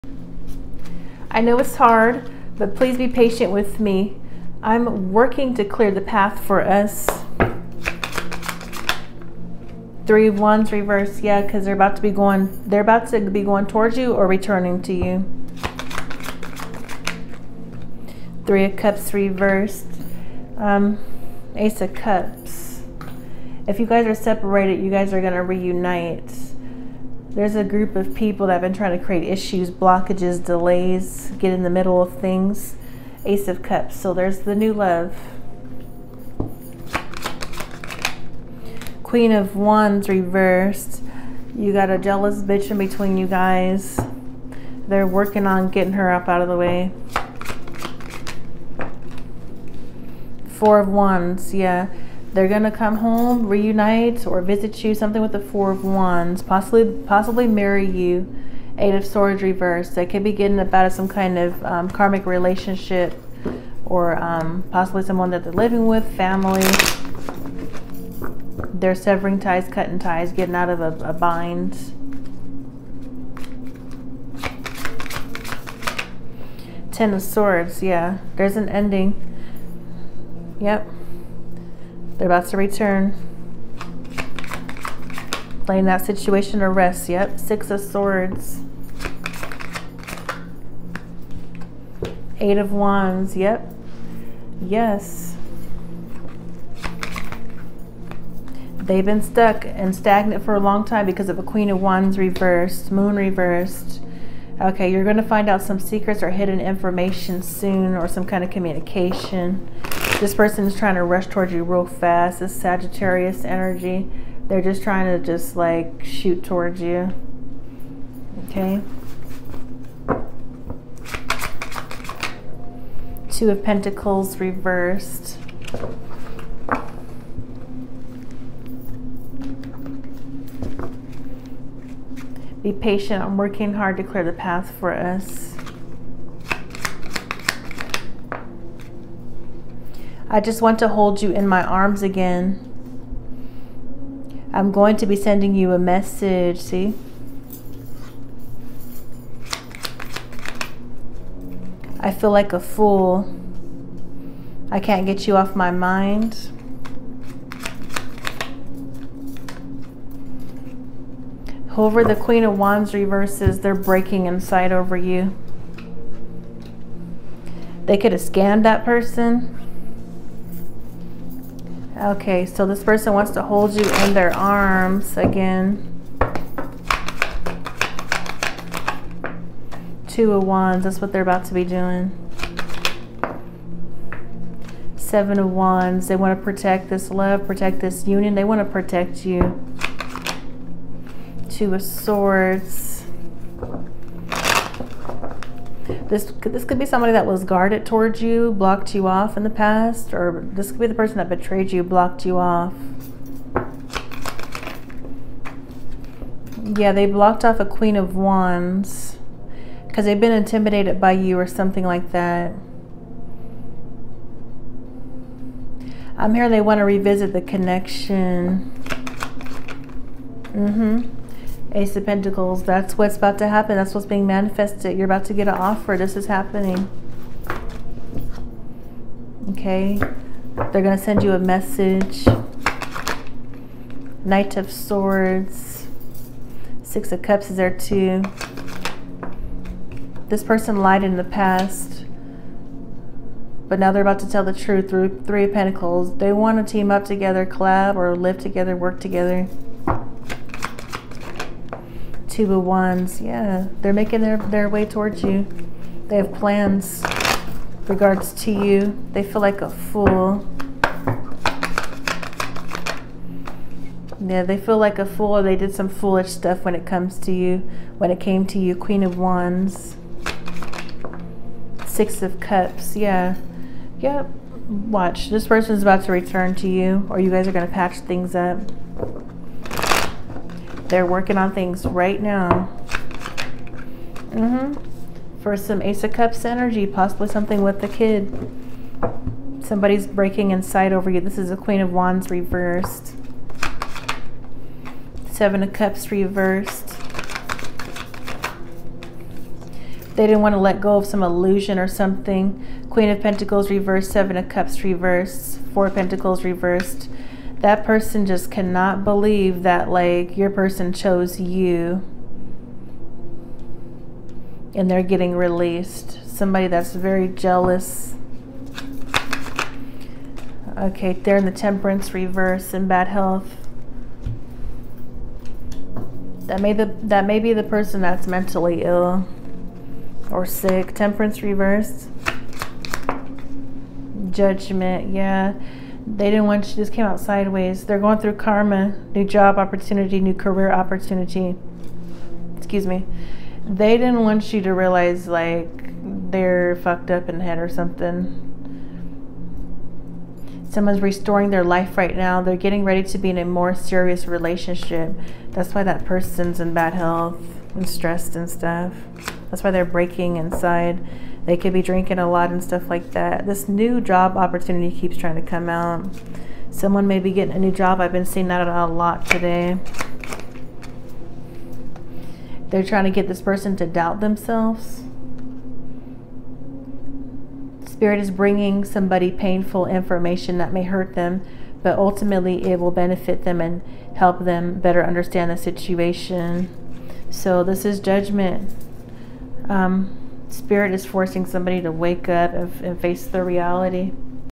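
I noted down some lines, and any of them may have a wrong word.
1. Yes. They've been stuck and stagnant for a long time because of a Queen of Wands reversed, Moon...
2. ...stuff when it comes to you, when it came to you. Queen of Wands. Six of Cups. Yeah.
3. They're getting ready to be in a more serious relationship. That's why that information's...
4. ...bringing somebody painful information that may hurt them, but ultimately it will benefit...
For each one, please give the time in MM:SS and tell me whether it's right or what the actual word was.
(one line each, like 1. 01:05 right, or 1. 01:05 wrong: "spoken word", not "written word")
1. 01:34 right
2. 04:26 right
3. 05:52 wrong: "person", not "information"
4. 06:18 right.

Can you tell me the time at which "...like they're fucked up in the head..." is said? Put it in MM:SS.
05:45.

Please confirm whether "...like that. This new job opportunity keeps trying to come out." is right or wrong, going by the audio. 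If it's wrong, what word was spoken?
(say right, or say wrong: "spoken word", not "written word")
right.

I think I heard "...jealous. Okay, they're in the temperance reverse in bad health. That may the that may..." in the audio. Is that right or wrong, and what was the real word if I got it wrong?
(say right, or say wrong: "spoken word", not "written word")
right.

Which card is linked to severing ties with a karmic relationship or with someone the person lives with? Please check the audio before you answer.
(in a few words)
Eight of Swords reversed.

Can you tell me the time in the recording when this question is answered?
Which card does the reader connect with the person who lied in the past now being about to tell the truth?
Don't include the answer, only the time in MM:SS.
04:05.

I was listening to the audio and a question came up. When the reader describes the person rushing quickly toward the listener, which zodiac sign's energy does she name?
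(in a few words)
Sagittarius.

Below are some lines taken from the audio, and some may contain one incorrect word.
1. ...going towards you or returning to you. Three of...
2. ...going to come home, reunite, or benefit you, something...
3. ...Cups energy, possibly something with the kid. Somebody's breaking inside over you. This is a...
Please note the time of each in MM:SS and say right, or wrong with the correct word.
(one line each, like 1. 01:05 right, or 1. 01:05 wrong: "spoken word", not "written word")
1. 00:13 right
2. 00:52 wrong: "visit", not "benefit"
3. 04:46 right.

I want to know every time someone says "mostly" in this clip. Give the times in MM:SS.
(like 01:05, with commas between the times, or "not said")
not said.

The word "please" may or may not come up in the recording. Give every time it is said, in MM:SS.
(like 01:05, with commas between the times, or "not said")
00:02.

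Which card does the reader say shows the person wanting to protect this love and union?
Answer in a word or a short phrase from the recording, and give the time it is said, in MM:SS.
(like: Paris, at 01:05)
Seven of Wands, at 03:04.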